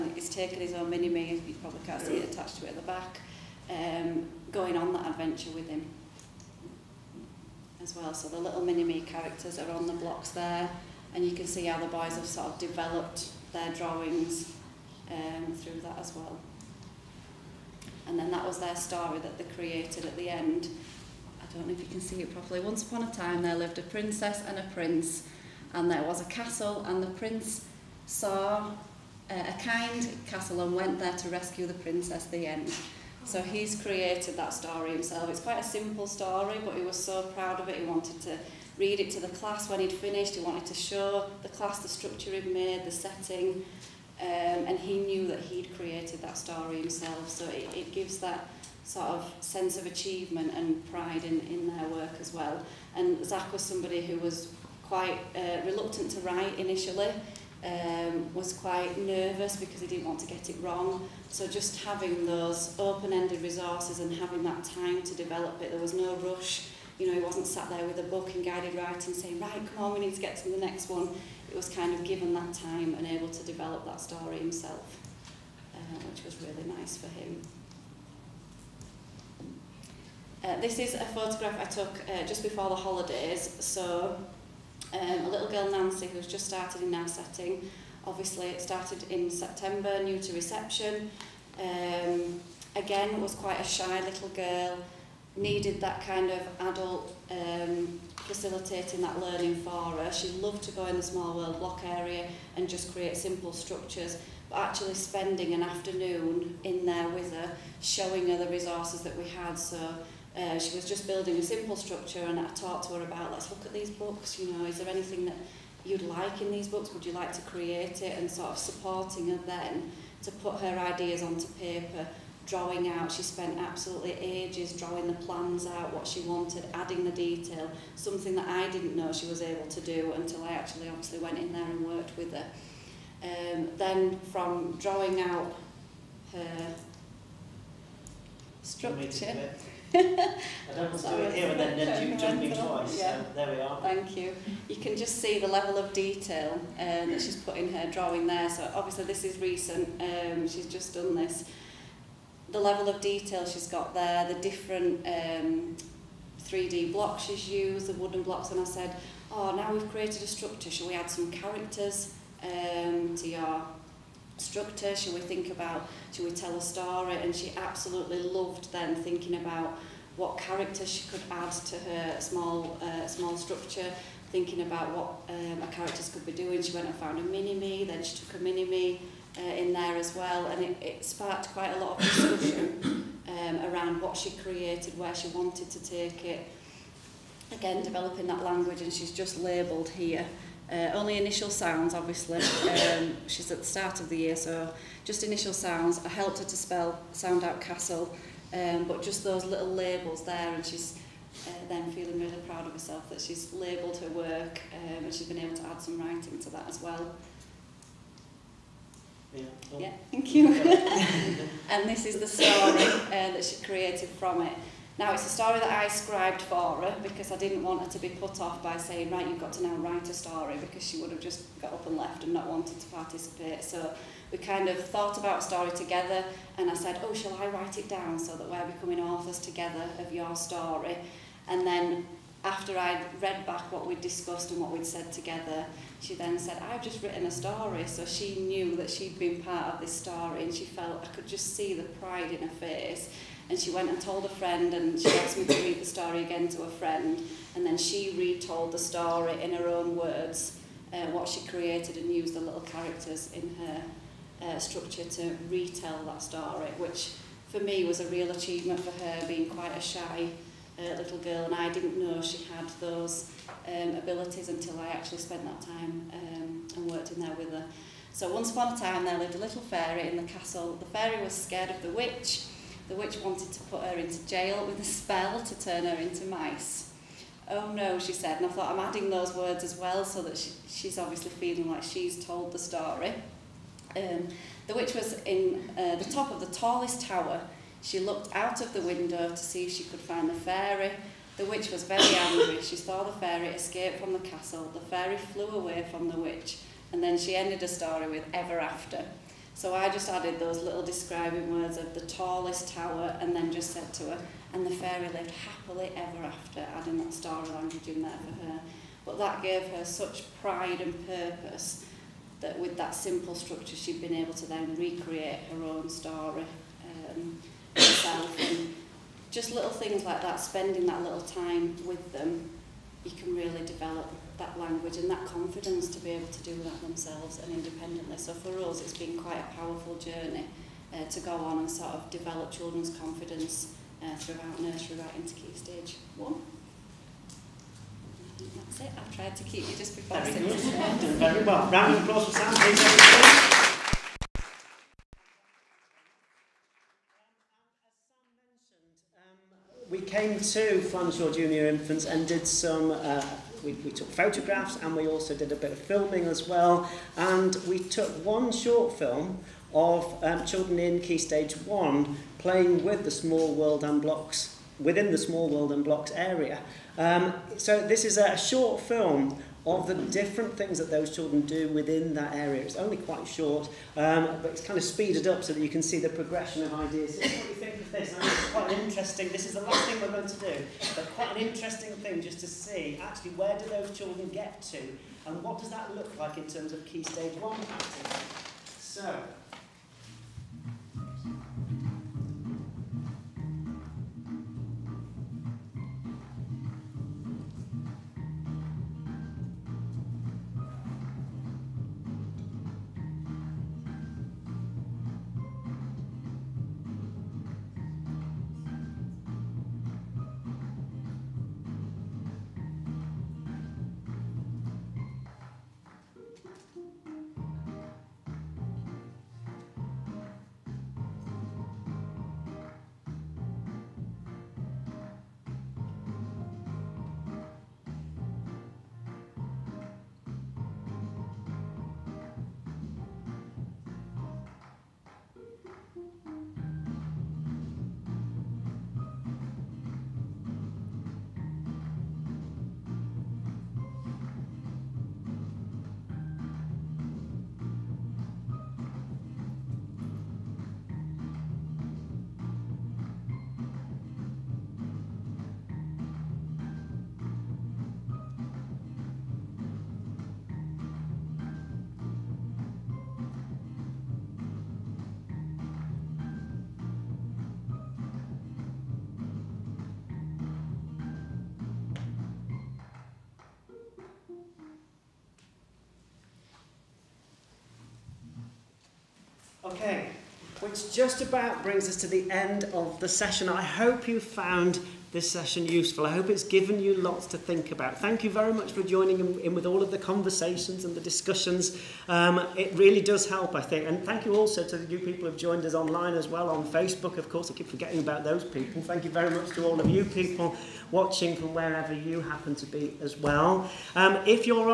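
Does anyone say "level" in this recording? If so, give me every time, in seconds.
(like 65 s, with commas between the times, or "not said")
145 s, 152 s.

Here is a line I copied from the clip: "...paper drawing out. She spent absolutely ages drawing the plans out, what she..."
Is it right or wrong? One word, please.
right.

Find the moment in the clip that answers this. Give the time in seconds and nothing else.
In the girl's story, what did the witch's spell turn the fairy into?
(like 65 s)
276 s.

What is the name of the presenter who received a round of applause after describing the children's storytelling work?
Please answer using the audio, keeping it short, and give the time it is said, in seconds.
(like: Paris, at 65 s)
Sam, at 342 s.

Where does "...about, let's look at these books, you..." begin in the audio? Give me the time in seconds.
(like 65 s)
113 s.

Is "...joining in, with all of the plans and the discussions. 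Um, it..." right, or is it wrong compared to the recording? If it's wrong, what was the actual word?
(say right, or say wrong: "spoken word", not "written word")
wrong: "conversations", not "plans".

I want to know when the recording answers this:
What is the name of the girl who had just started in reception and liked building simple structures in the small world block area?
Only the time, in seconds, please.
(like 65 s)
85 s.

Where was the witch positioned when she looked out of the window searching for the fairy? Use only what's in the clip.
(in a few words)
the top of the tallest tower.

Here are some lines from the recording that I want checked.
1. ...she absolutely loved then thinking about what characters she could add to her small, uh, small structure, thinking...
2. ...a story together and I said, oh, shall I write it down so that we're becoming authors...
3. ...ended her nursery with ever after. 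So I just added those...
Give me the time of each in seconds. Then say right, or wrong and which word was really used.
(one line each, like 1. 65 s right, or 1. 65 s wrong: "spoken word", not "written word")
1. 167 s right
2. 225 s right
3. 297 s wrong: "story", not "nursery".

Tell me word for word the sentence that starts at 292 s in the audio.
She saw the fairy escape from the castle.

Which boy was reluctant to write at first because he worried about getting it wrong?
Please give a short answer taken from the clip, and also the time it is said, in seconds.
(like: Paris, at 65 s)
Zach, at 53 s.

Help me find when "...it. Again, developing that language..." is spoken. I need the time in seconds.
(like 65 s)
186 s.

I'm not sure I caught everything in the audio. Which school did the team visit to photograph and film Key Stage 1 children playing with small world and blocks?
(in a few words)
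Flanshaw Junior Infants.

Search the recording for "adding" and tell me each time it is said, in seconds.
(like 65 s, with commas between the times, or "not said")
126 s, 278 s, 306 s.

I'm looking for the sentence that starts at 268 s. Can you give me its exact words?
So once upon a time there lived a little fairy in the castle.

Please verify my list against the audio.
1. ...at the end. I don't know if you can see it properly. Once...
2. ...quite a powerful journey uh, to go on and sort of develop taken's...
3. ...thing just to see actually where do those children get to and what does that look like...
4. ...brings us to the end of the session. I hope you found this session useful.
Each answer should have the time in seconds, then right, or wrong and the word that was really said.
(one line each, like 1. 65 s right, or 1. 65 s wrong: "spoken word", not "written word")
1. 20 s right
2. 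329 s wrong: "children", not "taken"
3. 381 s right
4. 481 s right.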